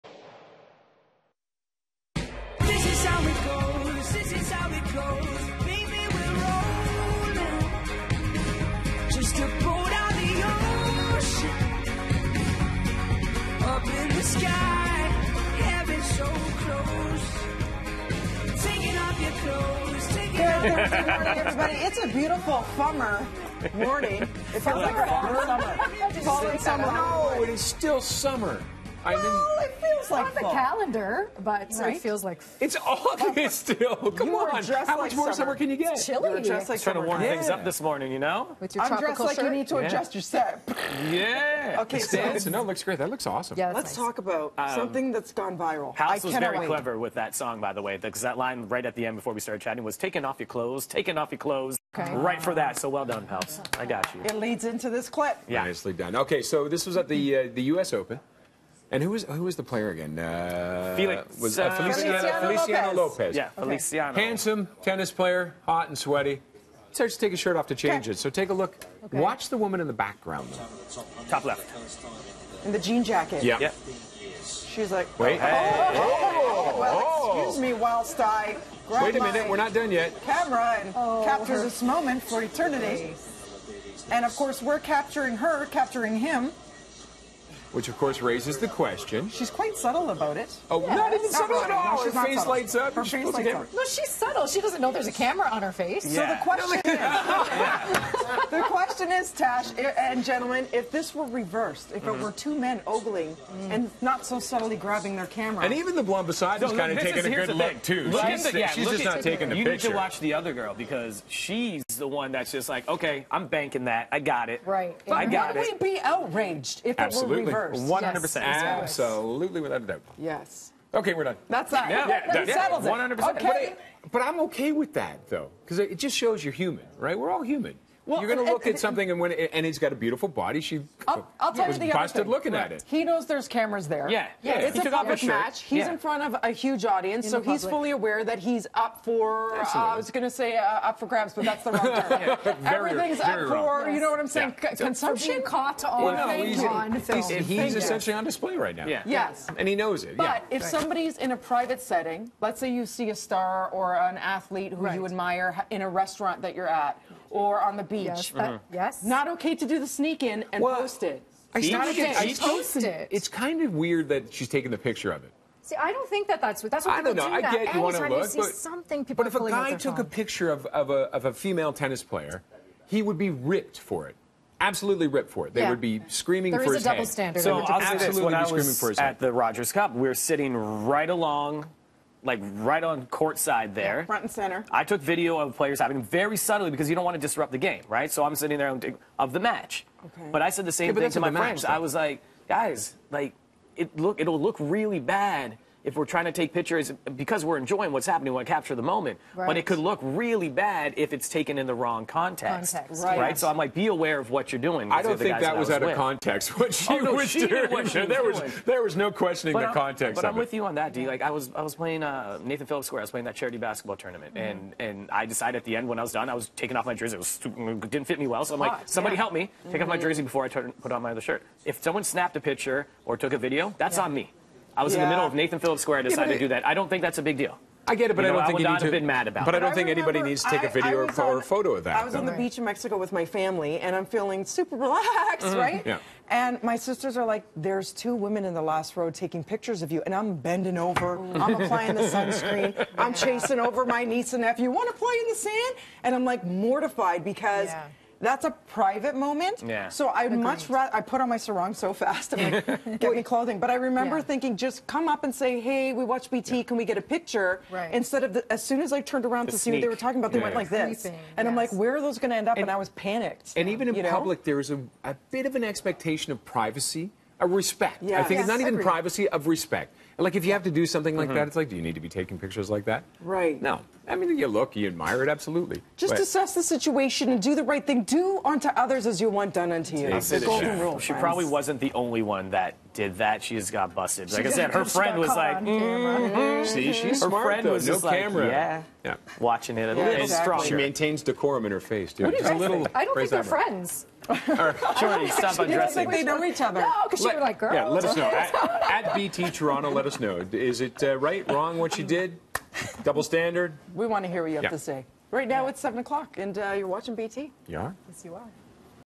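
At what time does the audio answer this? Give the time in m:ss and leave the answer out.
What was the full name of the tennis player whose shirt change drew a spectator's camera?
1:02.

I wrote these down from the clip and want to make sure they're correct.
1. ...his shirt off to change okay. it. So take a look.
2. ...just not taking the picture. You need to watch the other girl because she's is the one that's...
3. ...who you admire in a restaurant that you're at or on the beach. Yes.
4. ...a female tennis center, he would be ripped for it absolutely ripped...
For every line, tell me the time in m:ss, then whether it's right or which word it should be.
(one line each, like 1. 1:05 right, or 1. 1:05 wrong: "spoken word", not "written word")
1. 1:07 right
2. 1:48 right
3. 2:34 right
4. 2:51 wrong: "player", not "center".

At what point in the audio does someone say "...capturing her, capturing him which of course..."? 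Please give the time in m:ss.
1:24.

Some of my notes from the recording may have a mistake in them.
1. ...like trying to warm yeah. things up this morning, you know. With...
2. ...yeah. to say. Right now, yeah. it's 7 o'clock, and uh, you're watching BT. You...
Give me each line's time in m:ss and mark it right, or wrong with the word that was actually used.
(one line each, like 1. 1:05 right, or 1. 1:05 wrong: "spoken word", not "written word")
1. 0:36 right
2. 5:04 right.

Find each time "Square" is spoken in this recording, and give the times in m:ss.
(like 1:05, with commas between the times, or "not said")
3:32, 3:45.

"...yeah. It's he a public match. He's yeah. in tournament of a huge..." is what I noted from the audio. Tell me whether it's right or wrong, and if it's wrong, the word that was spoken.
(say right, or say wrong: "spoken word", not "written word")
wrong: "front", not "tournament".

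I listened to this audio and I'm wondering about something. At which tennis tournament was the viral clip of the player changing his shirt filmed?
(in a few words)
U.S. Open.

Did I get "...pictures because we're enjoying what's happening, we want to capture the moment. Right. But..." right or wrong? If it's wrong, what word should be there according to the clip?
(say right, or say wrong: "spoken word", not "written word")
right.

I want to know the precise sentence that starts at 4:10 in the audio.
much rather I put on my sarong so fast.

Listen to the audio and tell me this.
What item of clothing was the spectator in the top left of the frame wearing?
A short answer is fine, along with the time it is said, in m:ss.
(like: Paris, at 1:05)
jean jacket, at 1:12.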